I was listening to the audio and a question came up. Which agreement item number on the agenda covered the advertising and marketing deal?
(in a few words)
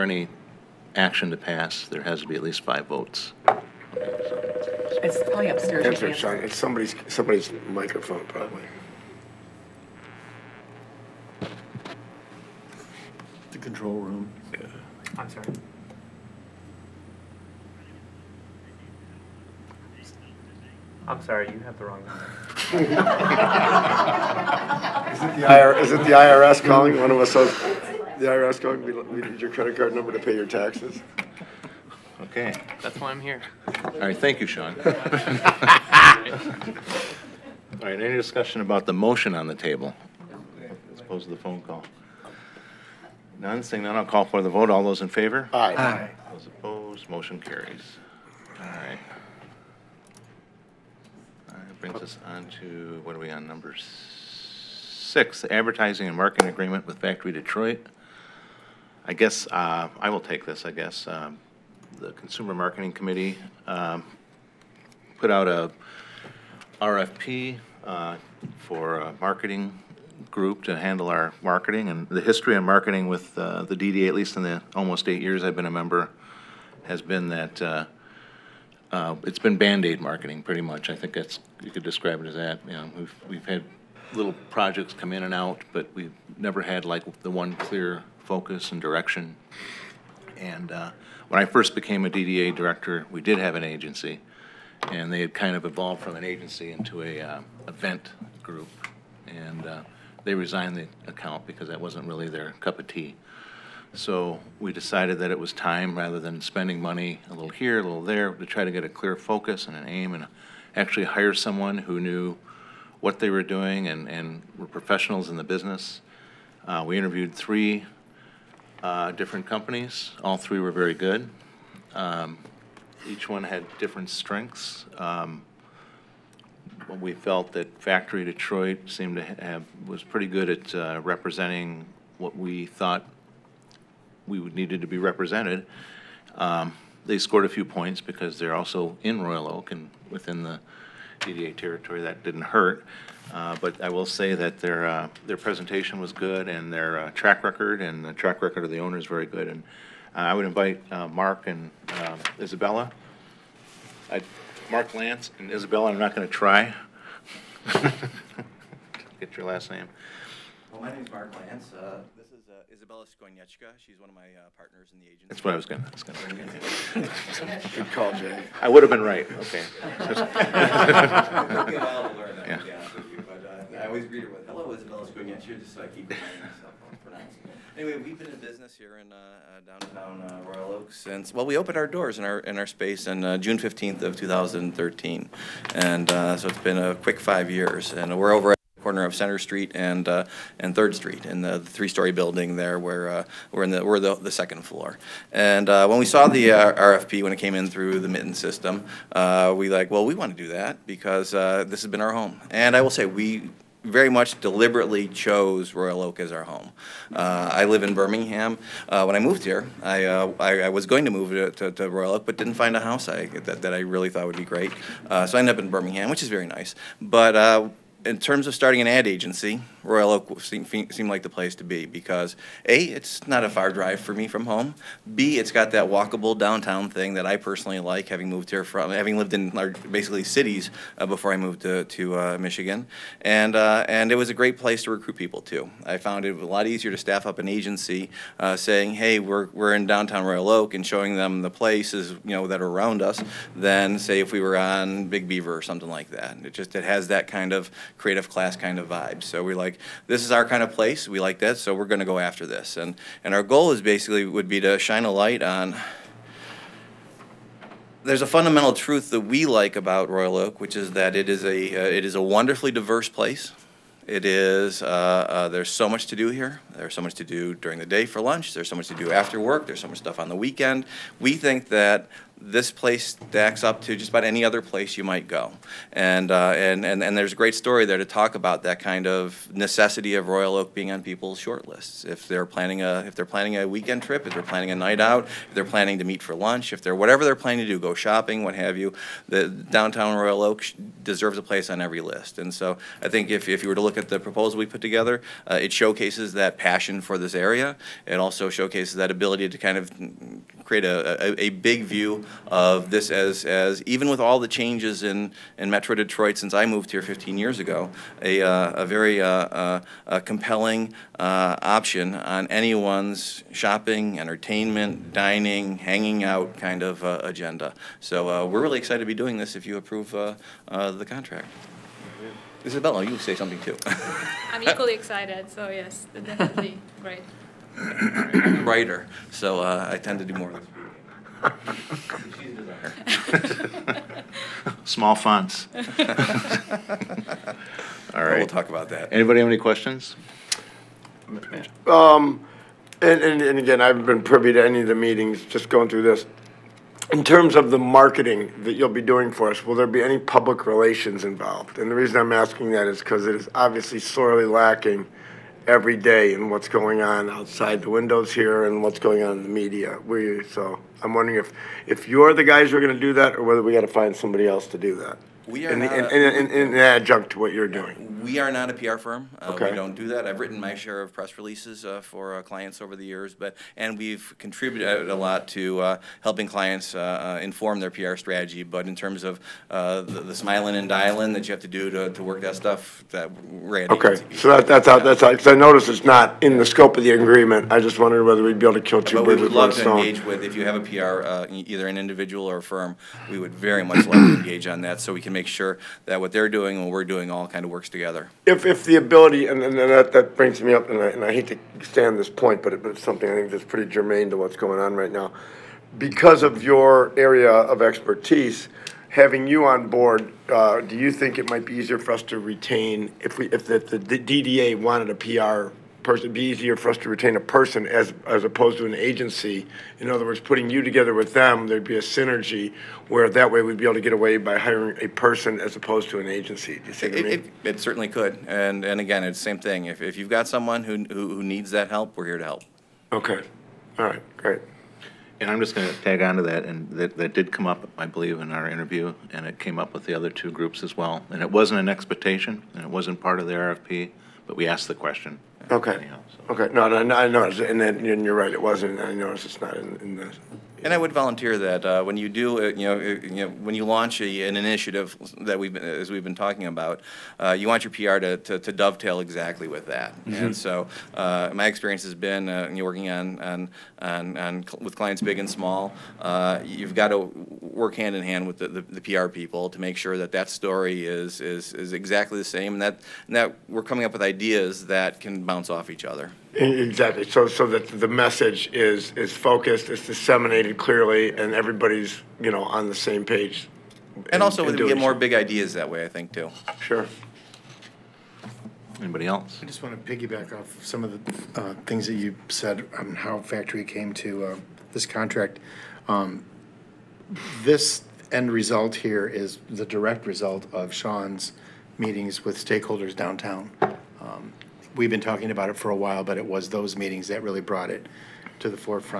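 6.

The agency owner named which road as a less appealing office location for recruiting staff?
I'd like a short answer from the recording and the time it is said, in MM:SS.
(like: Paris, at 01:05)
Big Beaver, at 04:05.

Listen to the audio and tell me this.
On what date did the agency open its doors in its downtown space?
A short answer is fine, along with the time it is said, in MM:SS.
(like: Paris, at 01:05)
June 15, 2013, at 03:03.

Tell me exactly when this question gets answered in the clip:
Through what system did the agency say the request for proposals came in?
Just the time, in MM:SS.
03:18.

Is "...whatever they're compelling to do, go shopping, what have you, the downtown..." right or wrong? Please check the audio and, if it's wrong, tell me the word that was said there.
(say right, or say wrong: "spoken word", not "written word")
wrong: "planning", not "compelling".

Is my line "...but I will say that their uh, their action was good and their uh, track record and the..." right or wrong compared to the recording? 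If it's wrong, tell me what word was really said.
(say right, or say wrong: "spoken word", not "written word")
wrong: "presentation", not "action".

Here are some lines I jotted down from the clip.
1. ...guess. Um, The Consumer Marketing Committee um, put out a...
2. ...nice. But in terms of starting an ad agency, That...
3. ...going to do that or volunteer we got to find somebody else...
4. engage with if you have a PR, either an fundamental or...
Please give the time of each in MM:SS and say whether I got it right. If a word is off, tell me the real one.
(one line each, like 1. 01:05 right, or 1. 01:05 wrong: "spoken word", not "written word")
1. 01:00 right
2. 03:36 wrong: "Royal", not "That"
3. 06:02 wrong: "whether", not "volunteer"
4. 06:29 wrong: "individual", not "fundamental".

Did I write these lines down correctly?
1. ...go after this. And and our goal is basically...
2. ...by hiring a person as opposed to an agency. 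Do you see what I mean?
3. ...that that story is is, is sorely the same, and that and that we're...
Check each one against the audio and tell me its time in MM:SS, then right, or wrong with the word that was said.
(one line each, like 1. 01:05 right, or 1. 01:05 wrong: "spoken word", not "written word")
1. 04:12 right
2. 07:04 right
3. 07:50 wrong: "exactly", not "sorely".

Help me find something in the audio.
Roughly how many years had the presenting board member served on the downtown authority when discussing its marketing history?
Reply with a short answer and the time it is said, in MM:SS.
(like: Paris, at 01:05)
8, at 01:14.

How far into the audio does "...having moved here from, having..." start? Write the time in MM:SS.
03:48.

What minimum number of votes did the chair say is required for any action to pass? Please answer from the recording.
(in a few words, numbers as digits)
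5.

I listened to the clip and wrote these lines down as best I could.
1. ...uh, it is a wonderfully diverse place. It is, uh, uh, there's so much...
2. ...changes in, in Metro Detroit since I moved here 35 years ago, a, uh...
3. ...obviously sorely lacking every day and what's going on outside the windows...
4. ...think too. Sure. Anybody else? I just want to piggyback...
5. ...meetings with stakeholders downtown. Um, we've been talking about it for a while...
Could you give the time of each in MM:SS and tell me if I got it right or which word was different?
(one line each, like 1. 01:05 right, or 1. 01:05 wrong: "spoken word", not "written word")
1. 04:21 right
2. 05:04 wrong: "15", not "35"
3. 05:53 right
4. 08:06 right
5. 08:21 right.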